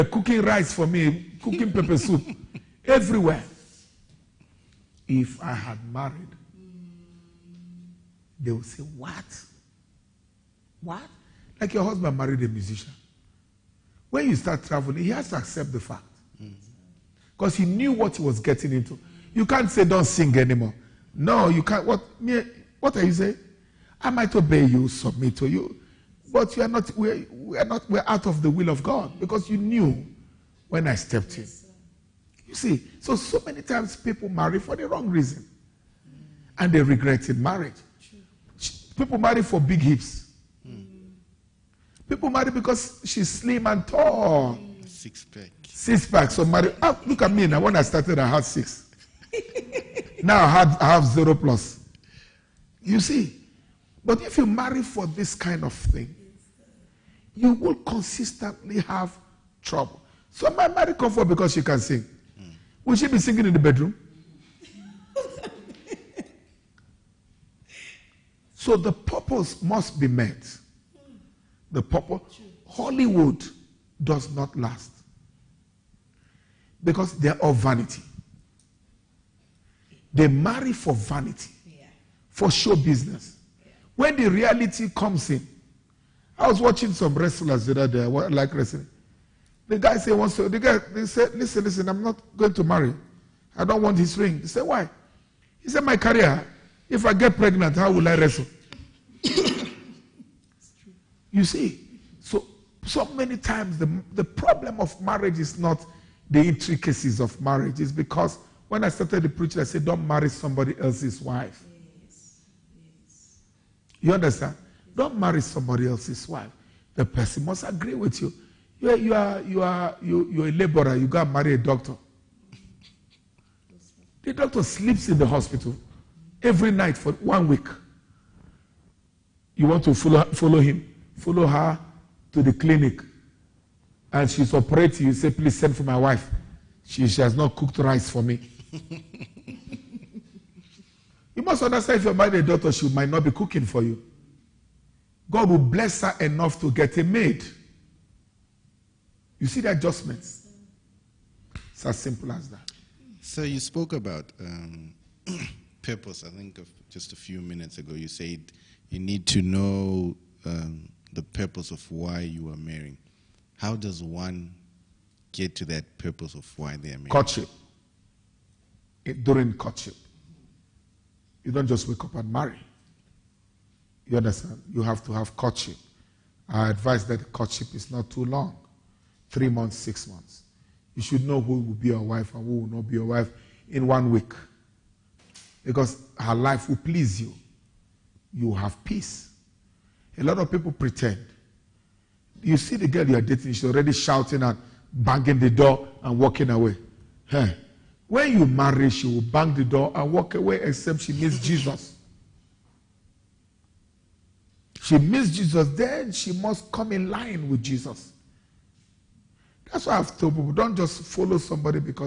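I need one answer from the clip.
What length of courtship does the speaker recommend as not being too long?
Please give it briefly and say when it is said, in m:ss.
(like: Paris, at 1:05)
3 months, 6 months, at 2:59.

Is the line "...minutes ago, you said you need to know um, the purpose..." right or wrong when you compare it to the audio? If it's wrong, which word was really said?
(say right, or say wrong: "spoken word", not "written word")
right.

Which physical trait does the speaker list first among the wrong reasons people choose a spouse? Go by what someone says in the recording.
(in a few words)
big hips.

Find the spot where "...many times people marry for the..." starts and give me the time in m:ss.
0:33.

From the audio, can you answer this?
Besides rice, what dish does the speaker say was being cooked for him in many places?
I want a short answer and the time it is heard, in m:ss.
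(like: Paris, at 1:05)
pepper soup, at 0:01.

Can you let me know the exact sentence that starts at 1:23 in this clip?
When the reality comes in, I was watching some wrestlers the other day.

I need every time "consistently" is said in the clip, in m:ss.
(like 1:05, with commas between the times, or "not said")
0:57.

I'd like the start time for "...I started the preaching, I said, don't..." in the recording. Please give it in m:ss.
1:48.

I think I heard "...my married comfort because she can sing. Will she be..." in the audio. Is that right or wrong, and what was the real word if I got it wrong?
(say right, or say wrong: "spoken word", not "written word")
right.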